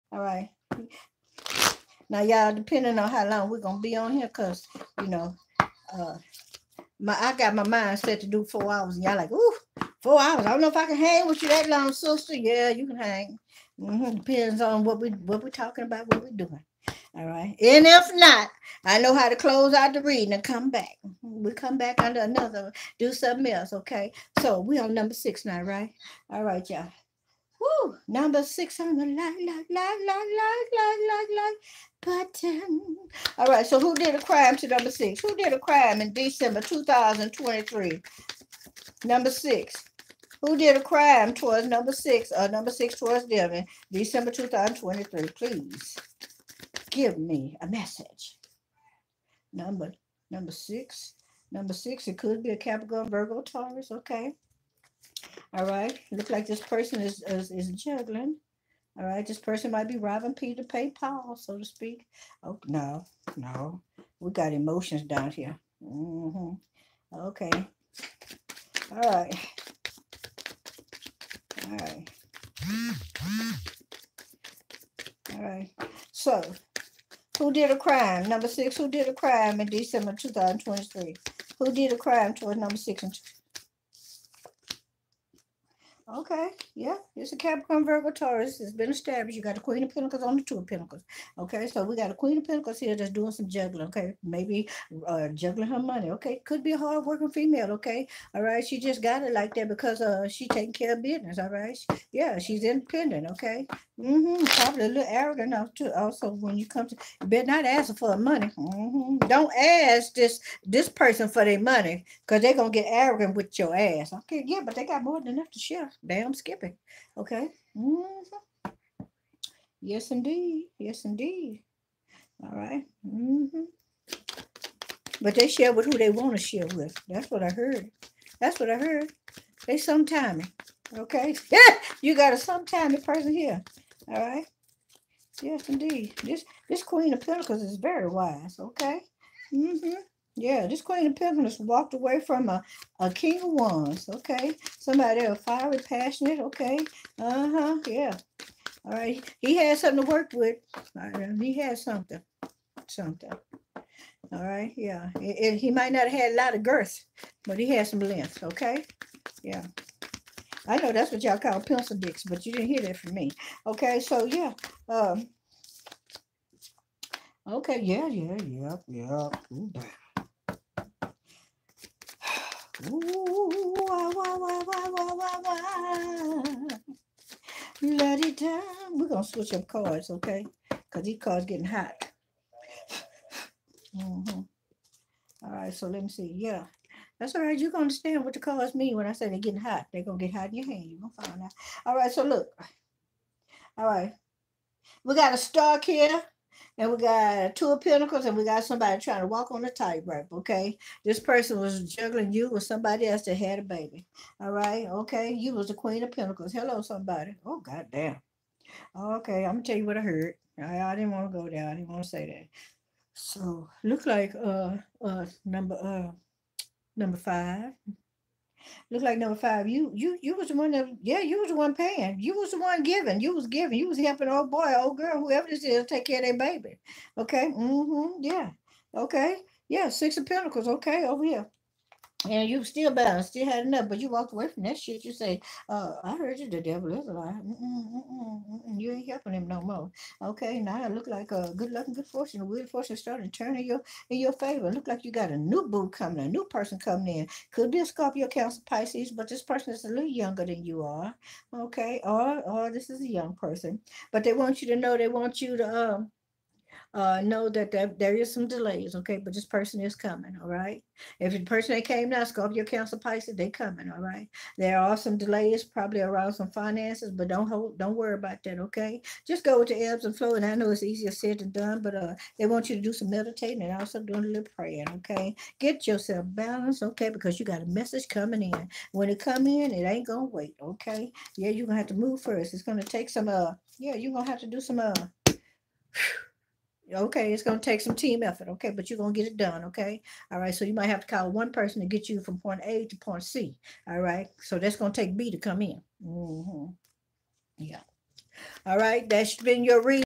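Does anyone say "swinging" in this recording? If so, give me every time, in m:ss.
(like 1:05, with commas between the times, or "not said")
not said.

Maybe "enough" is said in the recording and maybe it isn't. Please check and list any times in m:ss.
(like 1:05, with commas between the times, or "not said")
1:55, 3:53.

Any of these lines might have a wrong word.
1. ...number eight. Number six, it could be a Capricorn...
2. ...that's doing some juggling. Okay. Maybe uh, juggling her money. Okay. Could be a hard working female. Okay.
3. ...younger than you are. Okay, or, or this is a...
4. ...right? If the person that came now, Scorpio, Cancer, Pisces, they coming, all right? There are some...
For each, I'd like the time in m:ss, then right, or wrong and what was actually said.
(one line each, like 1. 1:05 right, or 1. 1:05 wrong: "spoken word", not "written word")
1. 0:50 wrong: "six", not "eight"
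2. 1:32 right
3. 4:10 right
4. 4:20 right.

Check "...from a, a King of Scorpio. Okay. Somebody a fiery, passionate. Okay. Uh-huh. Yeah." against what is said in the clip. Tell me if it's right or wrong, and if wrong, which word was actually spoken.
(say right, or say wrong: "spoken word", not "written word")
wrong: "Wands", not "Scorpio".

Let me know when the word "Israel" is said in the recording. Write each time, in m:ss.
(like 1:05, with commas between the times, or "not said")
not said.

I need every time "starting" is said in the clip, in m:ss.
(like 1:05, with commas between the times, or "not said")
4:02.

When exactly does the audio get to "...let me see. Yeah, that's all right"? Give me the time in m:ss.
3:05.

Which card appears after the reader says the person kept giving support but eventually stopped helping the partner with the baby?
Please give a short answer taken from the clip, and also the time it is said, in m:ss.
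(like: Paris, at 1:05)
Six of Pentacles, at 3:49.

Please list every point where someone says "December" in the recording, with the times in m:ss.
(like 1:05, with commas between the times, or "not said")
0:36, 0:43, 1:19.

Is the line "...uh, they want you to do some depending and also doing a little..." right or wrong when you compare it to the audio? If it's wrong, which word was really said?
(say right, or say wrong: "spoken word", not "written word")
wrong: "meditating", not "depending".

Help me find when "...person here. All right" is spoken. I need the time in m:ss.
2:13.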